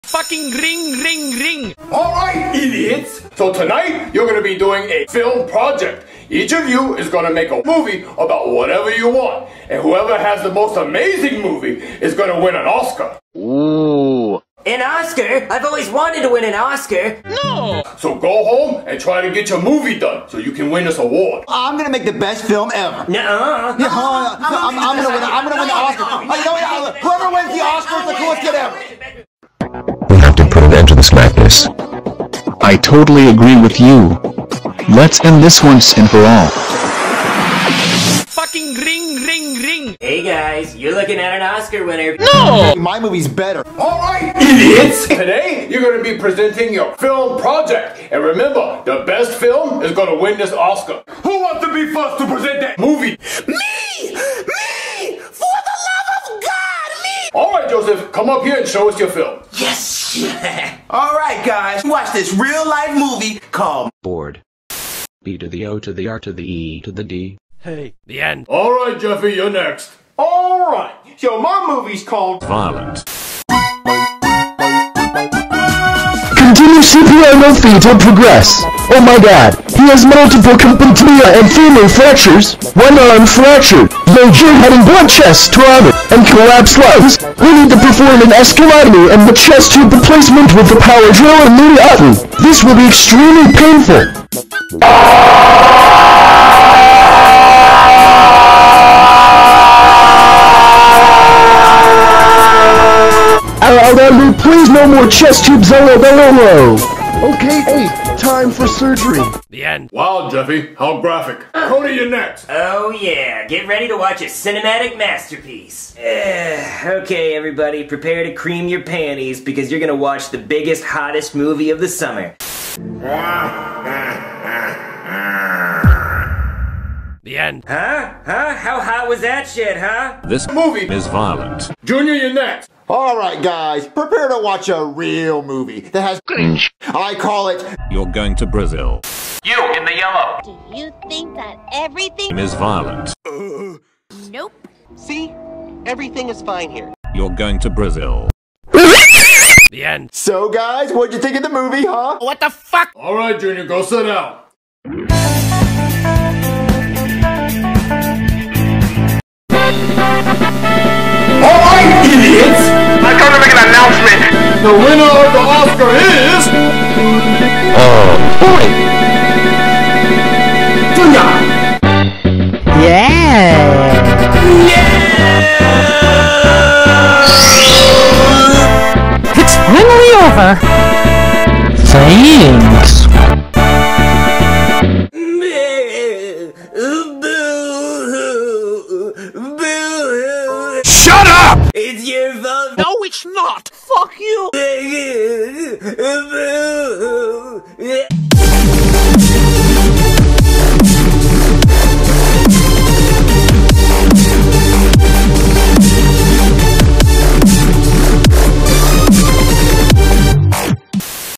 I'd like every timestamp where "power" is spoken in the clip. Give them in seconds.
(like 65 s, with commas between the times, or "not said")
90 s.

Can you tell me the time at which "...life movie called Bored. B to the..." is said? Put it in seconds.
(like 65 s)
62 s.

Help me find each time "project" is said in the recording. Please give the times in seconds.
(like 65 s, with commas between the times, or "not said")
5 s, 47 s.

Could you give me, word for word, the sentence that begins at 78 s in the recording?
Oh my god, he has multiple completely and femur fractures, one arm fractured.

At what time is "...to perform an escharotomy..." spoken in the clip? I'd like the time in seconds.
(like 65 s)
87 s.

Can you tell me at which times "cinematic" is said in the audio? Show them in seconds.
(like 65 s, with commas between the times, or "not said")
114 s.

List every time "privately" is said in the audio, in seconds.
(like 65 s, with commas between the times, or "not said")
not said.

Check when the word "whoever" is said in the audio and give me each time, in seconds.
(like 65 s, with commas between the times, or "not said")
9 s, 26 s.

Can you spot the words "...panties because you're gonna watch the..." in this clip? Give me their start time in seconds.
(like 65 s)
118 s.